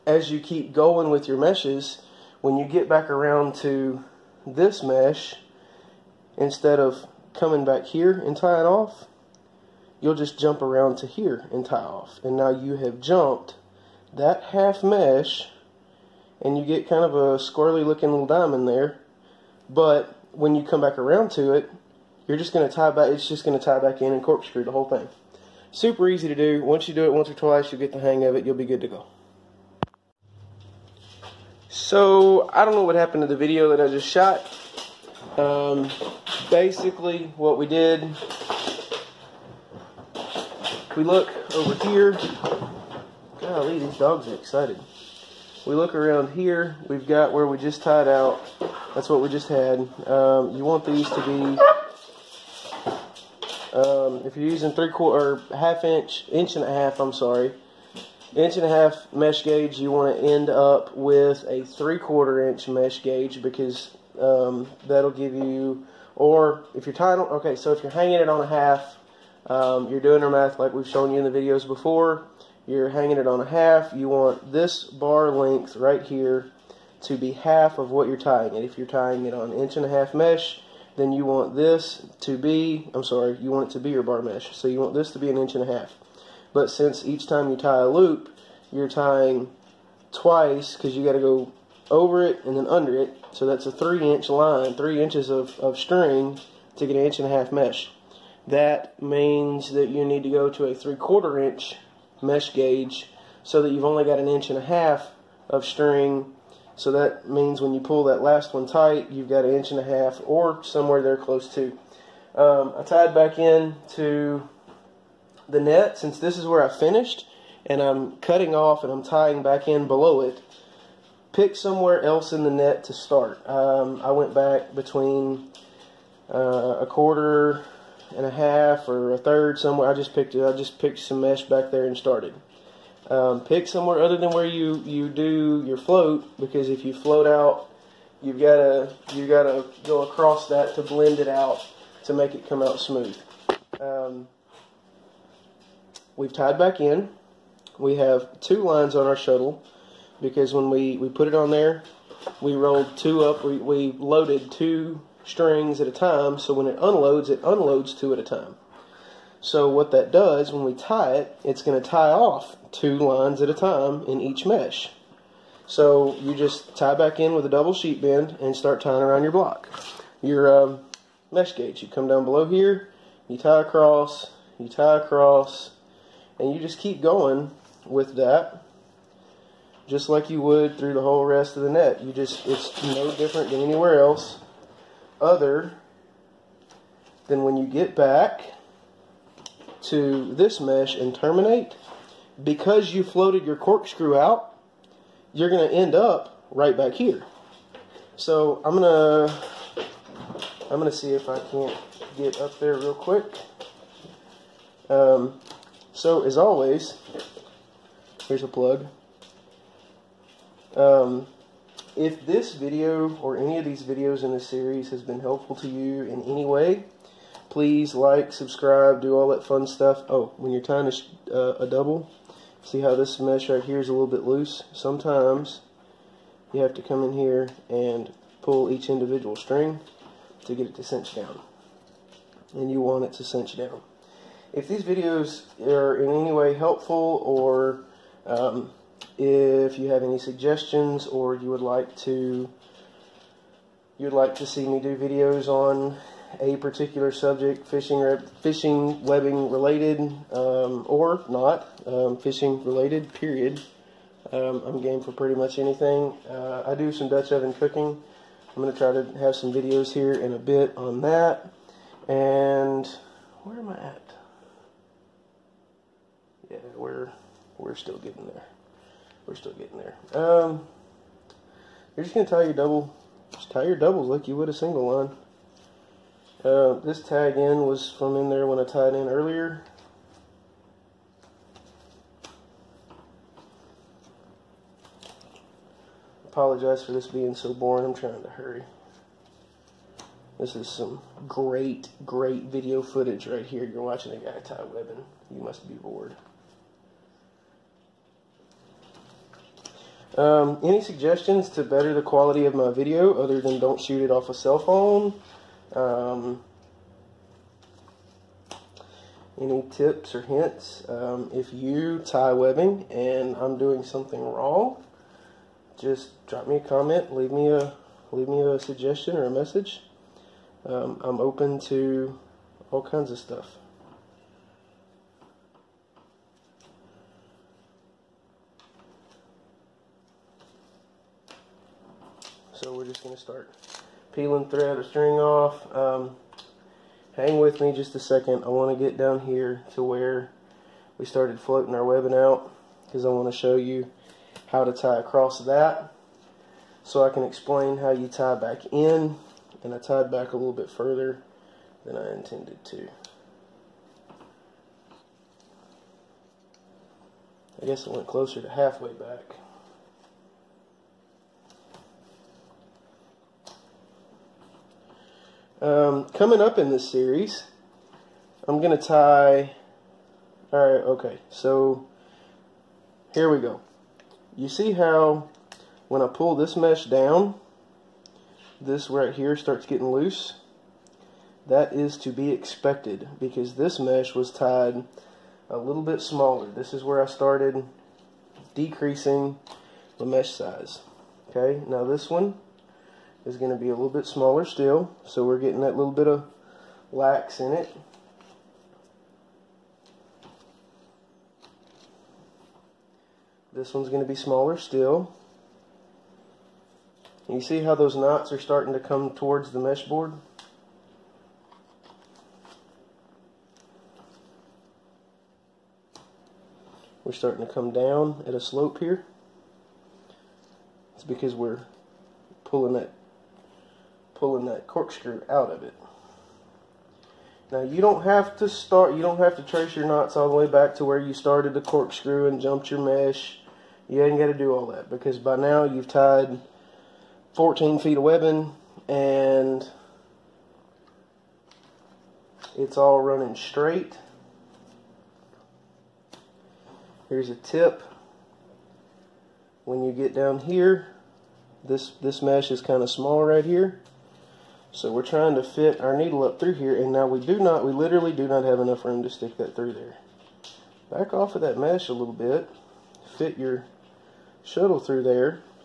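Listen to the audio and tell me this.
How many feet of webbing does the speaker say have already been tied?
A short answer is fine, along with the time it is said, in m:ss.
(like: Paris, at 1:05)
14 feet, at 7:17.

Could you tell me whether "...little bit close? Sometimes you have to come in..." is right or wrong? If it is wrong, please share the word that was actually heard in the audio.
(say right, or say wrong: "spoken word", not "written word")
wrong: "loose", not "close".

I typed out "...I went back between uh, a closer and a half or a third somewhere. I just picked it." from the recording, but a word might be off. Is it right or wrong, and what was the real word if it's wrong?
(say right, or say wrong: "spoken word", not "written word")
wrong: "quarter", not "closer".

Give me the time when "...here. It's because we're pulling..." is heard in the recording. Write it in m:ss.
6:58.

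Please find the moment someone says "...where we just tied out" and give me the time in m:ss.
0:47.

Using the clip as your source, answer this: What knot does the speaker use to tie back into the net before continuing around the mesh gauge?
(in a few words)
double sheet bend.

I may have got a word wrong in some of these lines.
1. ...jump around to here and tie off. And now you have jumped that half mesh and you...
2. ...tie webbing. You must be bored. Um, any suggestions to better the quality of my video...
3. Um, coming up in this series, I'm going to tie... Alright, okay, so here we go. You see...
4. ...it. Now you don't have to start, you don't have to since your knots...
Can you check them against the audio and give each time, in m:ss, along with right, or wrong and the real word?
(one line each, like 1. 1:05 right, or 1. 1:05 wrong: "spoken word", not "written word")
1. 0:10 right
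2. 4:54 right
3. 6:05 right
4. 7:05 wrong: "trace", not "since".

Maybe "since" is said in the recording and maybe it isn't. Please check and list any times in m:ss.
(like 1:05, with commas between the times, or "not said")
1:26, 1:55.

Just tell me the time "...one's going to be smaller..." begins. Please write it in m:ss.
6:43.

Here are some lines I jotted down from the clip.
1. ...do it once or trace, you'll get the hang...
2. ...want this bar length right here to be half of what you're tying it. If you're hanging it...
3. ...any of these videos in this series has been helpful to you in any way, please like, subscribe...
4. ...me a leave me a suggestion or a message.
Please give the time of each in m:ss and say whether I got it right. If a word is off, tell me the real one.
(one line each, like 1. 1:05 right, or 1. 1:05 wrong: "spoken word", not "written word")
1. 0:26 wrong: "twice", not "trace"
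2. 1:14 wrong: "tying", not "hanging"
3. 3:33 right
4. 5:17 right.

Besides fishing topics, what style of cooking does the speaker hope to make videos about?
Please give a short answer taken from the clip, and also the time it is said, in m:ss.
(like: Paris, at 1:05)
Dutch oven cooking, at 4:17.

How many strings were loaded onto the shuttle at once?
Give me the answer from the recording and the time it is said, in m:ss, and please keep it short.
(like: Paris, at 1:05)
2, at 2:37.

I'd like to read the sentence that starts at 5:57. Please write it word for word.
I guess it went closer to halfway back.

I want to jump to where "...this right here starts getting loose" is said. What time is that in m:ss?
6:18.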